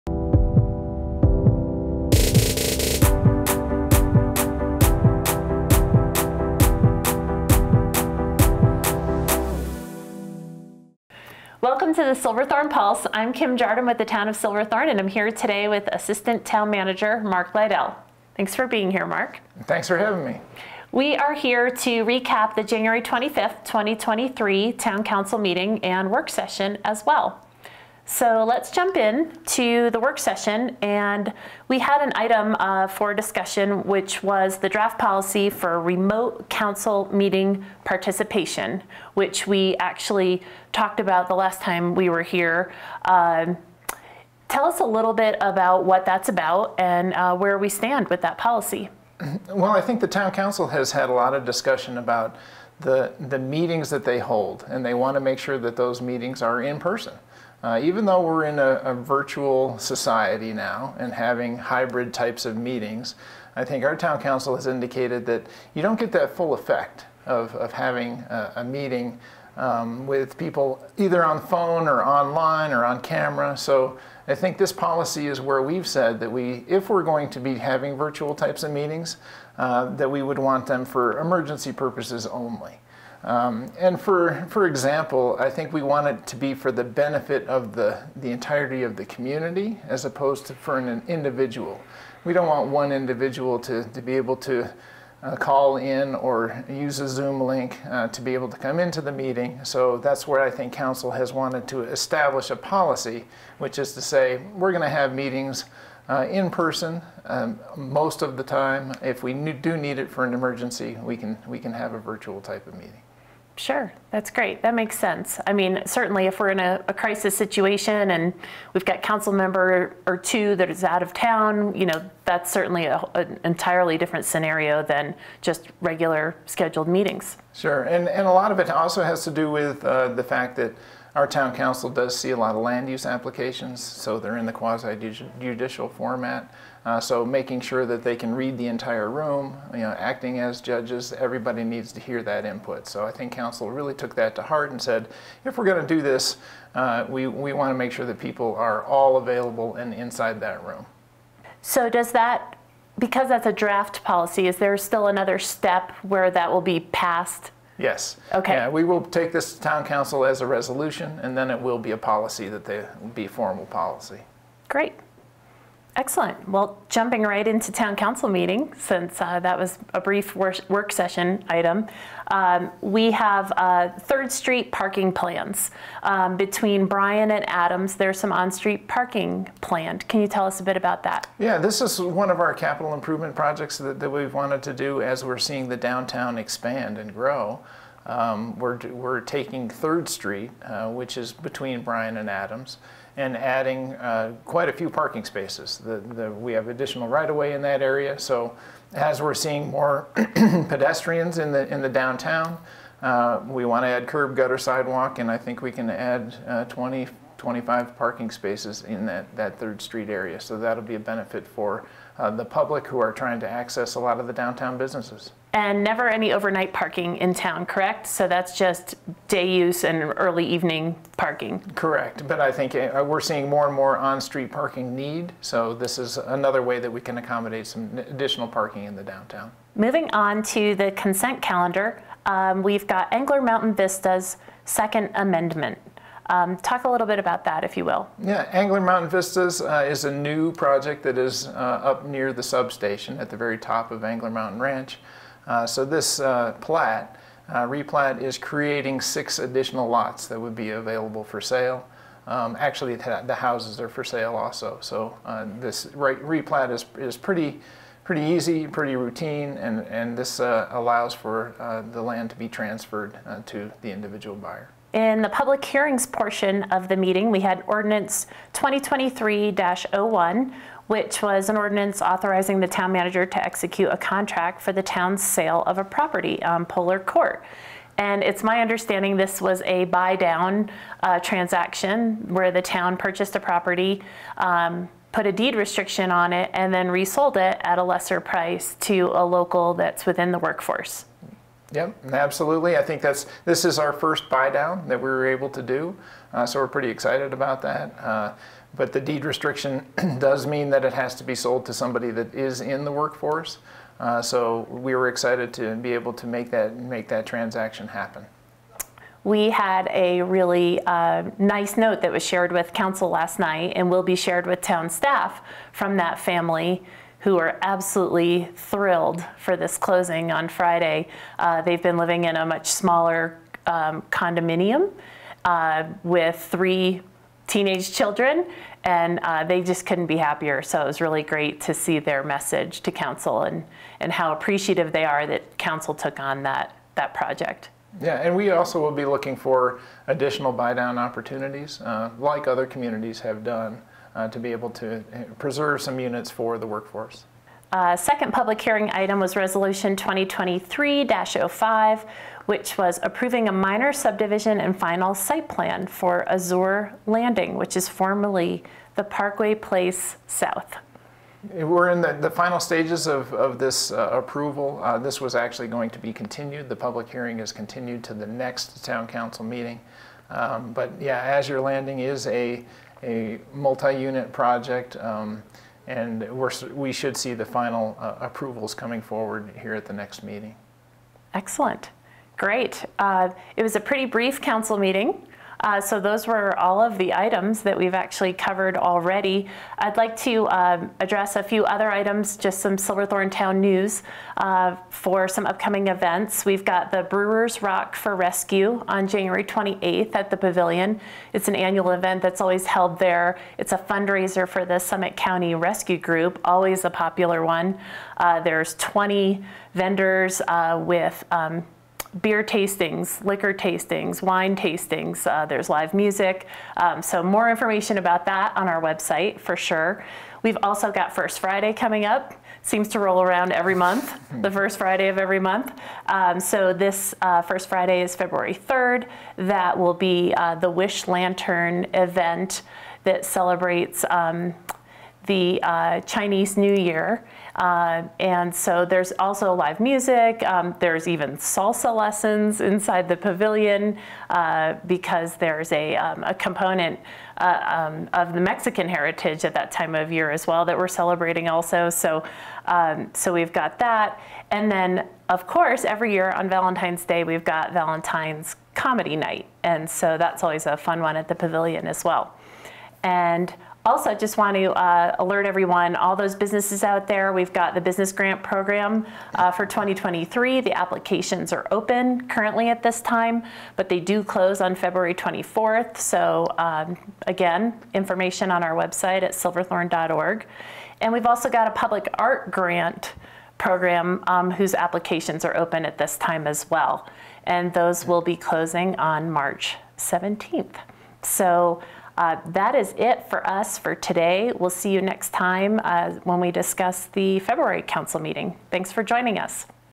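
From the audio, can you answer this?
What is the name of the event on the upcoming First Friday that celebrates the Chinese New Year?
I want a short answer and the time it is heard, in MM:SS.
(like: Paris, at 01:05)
Wish Lantern, at 07:10.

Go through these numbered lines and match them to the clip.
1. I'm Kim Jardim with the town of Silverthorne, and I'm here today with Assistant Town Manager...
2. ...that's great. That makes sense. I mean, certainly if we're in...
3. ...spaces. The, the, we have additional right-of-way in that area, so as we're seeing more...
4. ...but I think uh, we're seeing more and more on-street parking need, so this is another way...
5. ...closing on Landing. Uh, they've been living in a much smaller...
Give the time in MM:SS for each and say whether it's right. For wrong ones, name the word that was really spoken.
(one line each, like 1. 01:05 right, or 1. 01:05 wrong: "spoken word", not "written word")
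1. 00:13 right
2. 01:54 right
3. 03:15 right
4. 03:42 right
5. 05:19 wrong: "Friday", not "Landing".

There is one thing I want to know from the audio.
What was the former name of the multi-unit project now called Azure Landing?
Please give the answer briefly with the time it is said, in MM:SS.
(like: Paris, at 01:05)
Parkway Place South, at 05:59.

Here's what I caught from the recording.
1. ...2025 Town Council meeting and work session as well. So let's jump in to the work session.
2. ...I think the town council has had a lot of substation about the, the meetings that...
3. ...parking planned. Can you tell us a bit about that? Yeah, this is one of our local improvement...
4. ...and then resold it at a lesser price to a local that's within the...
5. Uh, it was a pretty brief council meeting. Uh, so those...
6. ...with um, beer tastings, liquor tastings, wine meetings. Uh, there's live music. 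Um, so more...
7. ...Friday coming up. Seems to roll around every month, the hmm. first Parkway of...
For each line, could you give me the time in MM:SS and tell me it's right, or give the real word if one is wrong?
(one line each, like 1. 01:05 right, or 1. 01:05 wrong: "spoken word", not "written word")
1. 00:23 wrong: "2023", not "2025"
2. 00:49 wrong: "discussion", not "substation"
3. 02:58 wrong: "capital", not "local"
4. 04:46 right
5. 06:22 right
6. 06:50 wrong: "tastings", not "meetings"
7. 07:01 wrong: "Friday", not "Parkway".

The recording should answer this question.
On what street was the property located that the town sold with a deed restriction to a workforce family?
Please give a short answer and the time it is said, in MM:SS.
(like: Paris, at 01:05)
Polar Court, at 04:36.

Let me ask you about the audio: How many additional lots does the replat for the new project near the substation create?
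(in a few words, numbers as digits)
6.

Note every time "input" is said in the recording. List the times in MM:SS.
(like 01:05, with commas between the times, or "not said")
02:22.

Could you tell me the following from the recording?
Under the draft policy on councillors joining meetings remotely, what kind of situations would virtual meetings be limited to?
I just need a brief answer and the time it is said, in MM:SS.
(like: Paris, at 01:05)
Emergency purposes, at 01:21.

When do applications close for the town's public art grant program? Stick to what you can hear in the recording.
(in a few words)
March 17.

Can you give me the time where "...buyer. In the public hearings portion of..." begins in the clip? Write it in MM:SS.
04:24.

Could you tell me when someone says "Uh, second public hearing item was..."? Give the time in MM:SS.
05:47.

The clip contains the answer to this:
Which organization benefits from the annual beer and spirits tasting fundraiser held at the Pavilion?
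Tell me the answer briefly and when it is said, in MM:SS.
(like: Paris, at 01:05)
Summit County Rescue Group, at 06:44.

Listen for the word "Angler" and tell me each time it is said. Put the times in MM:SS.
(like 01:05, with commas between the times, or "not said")
03:53, 03:58, 04:04.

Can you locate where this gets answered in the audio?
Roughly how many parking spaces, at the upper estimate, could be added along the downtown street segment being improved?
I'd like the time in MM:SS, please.
03:27.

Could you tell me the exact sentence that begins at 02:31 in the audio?
So does that, because that's a draft policy, is there still another step where that will be passed Yes.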